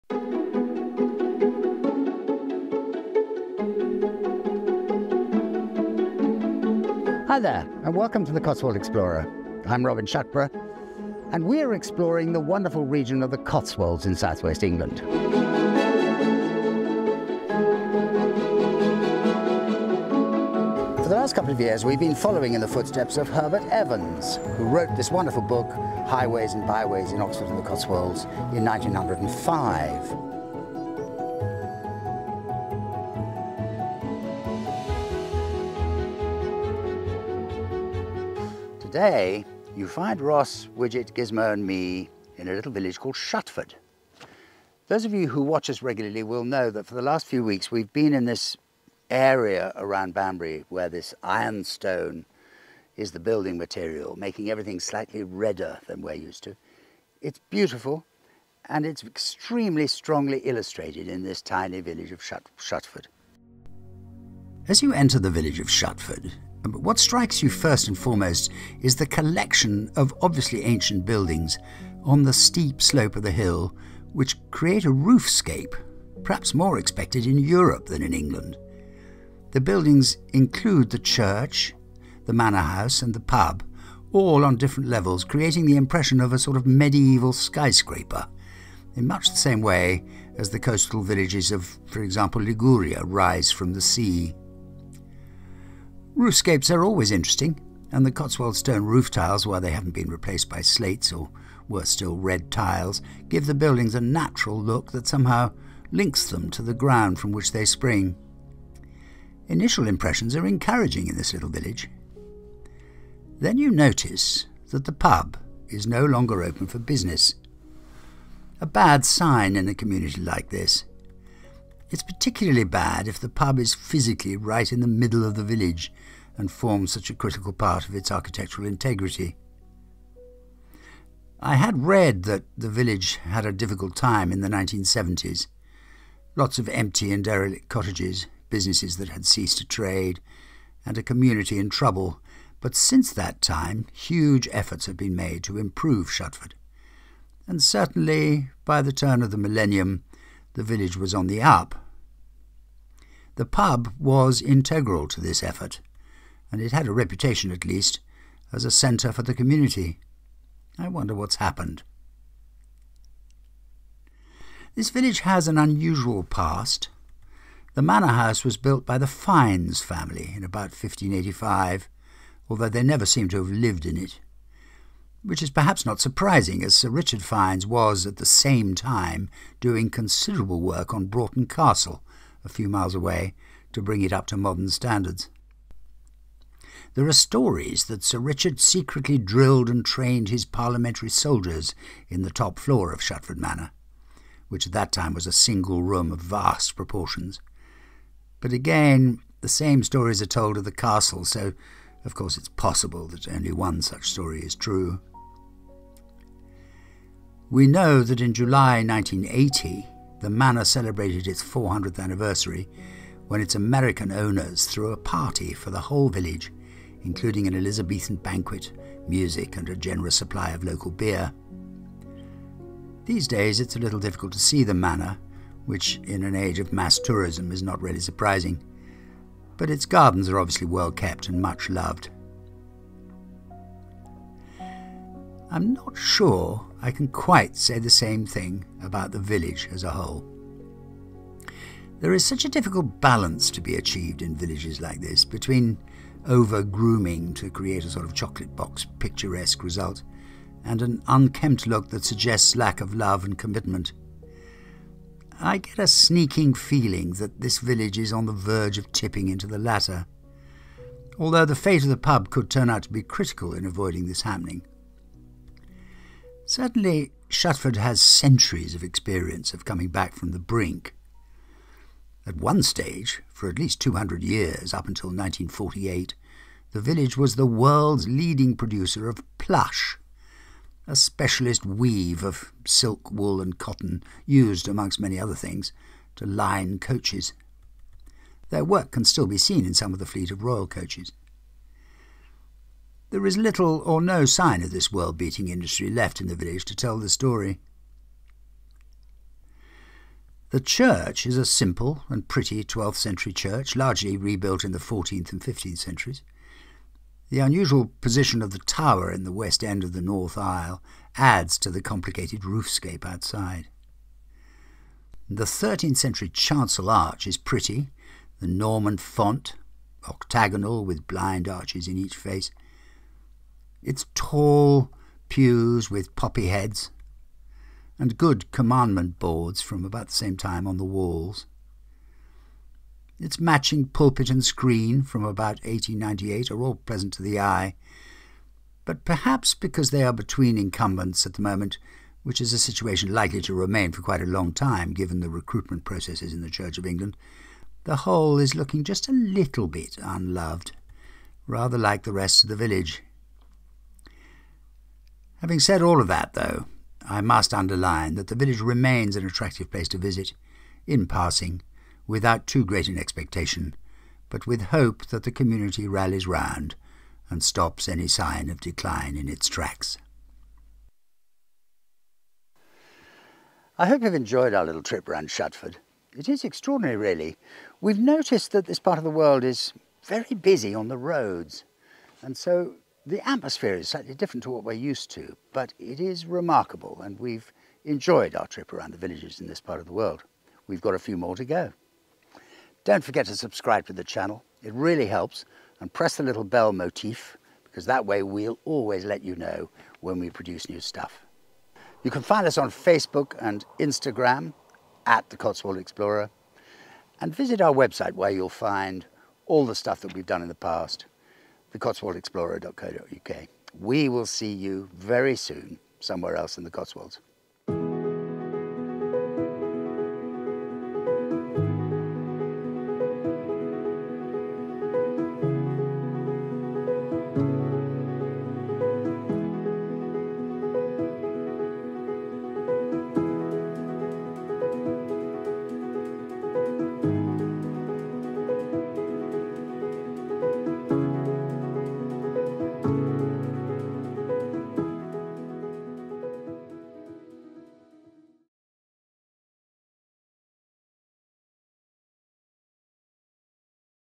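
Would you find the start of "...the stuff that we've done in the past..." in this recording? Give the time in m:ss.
6:49.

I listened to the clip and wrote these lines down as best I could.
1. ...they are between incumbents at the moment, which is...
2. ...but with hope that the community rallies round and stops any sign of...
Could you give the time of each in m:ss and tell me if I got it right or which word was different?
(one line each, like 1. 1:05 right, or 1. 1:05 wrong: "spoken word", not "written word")
1. 5:39 right
2. 6:04 right.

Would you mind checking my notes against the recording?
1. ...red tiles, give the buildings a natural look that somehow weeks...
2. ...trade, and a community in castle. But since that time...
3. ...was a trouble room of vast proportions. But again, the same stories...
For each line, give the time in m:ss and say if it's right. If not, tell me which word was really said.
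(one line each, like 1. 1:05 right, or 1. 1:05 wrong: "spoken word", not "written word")
1. 1:42 wrong: "links", not "weeks"
2. 2:19 wrong: "trouble", not "castle"
3. 3:15 wrong: "single", not "trouble".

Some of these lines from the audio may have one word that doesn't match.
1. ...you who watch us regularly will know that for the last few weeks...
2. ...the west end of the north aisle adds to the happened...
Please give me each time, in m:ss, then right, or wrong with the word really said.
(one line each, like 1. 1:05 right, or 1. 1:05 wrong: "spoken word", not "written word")
1. 0:45 right
2. 5:09 wrong: "complicated", not "happened".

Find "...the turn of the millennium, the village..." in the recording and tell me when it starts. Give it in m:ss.
2:28.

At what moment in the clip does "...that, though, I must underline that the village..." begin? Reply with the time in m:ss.
5:56.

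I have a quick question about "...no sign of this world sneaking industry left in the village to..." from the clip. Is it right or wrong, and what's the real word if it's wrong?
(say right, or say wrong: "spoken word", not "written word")
wrong: "beating", not "sneaking".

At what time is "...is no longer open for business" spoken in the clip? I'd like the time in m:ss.
1:55.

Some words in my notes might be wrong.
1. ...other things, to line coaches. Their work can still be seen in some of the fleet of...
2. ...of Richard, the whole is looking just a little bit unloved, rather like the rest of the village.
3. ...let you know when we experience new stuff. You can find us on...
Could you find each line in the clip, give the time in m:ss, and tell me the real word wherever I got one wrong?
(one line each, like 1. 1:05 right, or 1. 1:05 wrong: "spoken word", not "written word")
1. 4:45 right
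2. 5:46 wrong: "England", not "Richard"
3. 6:39 wrong: "produce", not "experience".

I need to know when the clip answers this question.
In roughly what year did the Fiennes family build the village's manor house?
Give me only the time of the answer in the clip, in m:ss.
2:50.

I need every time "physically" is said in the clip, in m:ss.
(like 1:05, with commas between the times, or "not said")
2:03.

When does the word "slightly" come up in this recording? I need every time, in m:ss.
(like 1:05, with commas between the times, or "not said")
0:54, 6:23.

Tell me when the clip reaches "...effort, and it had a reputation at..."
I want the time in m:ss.
2:35.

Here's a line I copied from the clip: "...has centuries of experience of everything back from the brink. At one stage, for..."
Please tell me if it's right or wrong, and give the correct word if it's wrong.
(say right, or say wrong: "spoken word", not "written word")
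wrong: "coming", not "everything".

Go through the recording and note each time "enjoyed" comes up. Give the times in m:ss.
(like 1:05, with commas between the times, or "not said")
6:14, 6:27.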